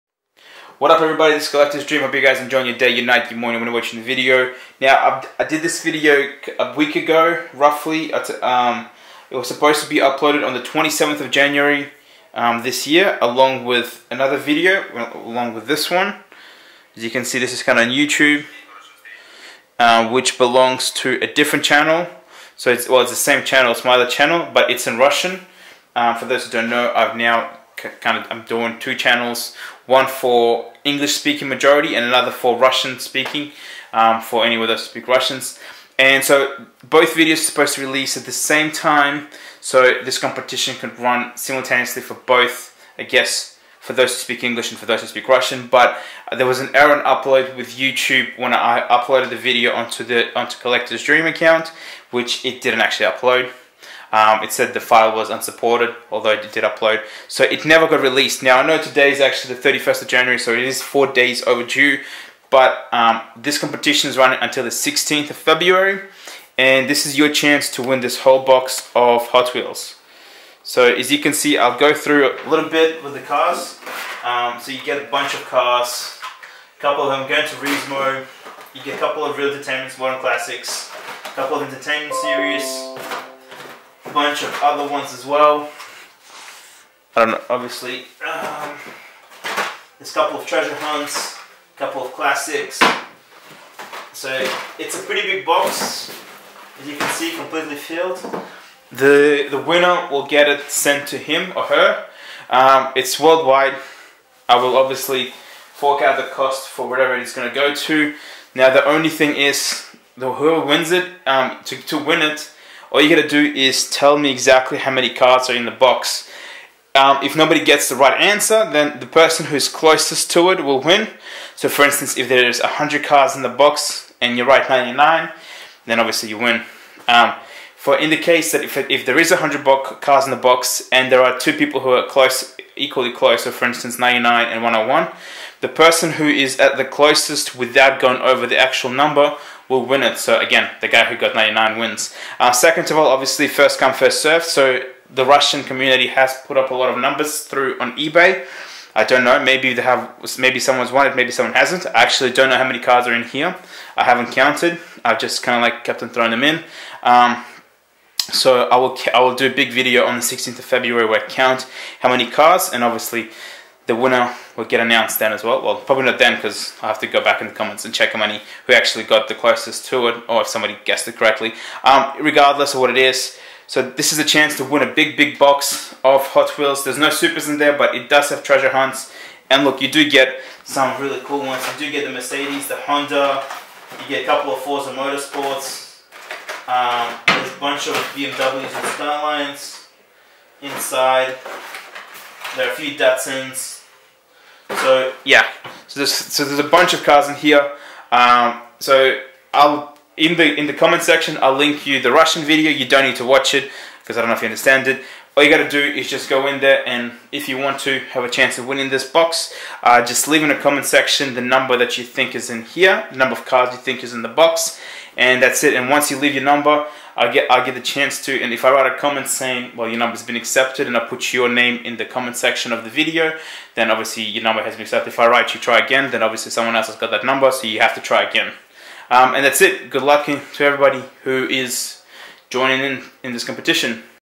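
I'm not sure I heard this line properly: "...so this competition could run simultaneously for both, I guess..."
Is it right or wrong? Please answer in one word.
right.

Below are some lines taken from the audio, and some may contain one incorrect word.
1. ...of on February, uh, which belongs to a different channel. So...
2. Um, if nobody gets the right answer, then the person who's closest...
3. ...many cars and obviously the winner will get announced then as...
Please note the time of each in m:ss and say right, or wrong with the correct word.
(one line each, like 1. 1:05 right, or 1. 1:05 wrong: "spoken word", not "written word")
1. 0:17 wrong: "YouTube", not "February"
2. 1:56 right
3. 2:42 right.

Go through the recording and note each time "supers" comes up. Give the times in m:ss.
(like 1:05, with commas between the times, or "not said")
2:57.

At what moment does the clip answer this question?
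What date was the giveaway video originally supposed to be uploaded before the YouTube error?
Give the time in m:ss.
0:10.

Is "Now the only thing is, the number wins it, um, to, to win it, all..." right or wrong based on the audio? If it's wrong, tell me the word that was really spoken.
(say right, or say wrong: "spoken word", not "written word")
wrong: "whoever", not "number".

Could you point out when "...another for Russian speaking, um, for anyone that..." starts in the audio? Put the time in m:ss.
0:32.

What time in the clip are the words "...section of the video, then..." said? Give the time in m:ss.
3:42.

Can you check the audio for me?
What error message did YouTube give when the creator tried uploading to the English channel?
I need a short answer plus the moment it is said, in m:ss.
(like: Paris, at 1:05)
file was unsupported, at 0:54.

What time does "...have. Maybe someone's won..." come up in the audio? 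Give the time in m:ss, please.
2:29.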